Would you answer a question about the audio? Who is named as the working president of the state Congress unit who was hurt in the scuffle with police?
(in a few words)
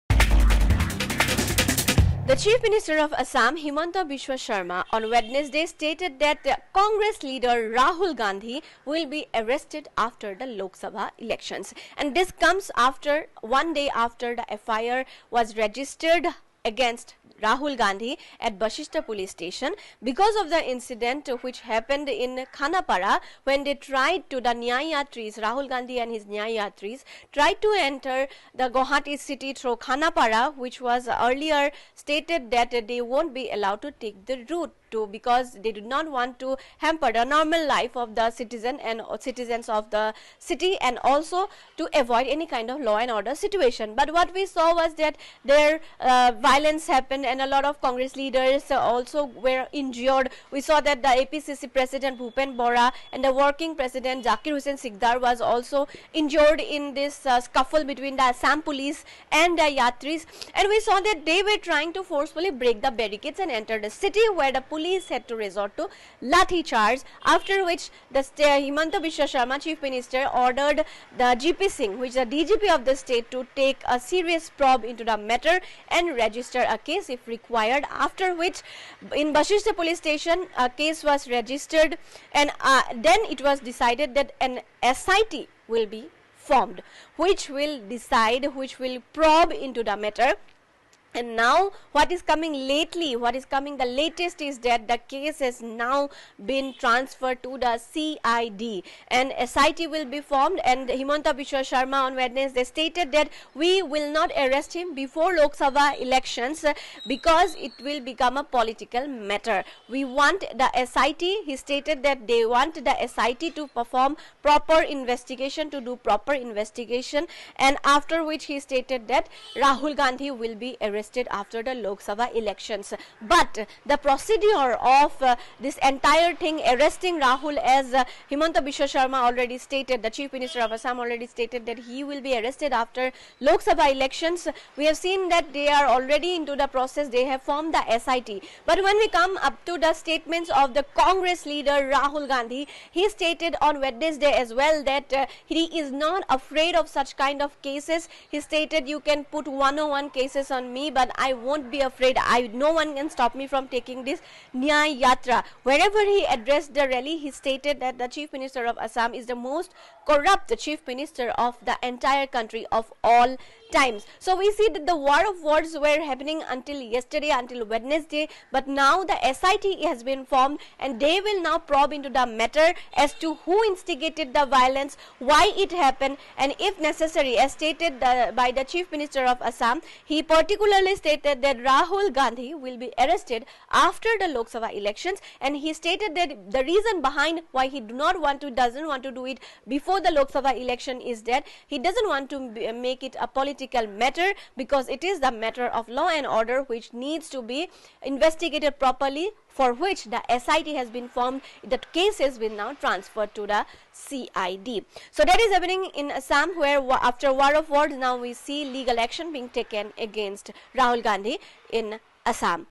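Zakir Hussain Sikdar.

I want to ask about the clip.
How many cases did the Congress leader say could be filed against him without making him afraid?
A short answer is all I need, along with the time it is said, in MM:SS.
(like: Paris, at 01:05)
101, at 02:29.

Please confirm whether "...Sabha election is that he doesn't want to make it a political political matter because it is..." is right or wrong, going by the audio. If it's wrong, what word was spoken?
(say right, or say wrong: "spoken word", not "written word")
right.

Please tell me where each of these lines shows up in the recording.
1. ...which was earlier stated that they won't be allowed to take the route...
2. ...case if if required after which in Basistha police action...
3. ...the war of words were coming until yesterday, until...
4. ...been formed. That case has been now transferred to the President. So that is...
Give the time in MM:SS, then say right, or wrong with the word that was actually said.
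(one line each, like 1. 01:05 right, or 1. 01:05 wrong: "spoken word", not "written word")
1. 00:30 right
2. 01:16 wrong: "station", not "action"
3. 02:44 wrong: "happening", not "coming"
4. 03:20 wrong: "CID", not "President".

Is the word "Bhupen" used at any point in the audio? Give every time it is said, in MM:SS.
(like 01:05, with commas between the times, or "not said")
00:52.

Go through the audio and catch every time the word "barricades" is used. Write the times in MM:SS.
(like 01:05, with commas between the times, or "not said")
01:02.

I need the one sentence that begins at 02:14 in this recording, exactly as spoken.
We have seen that they are already into the process.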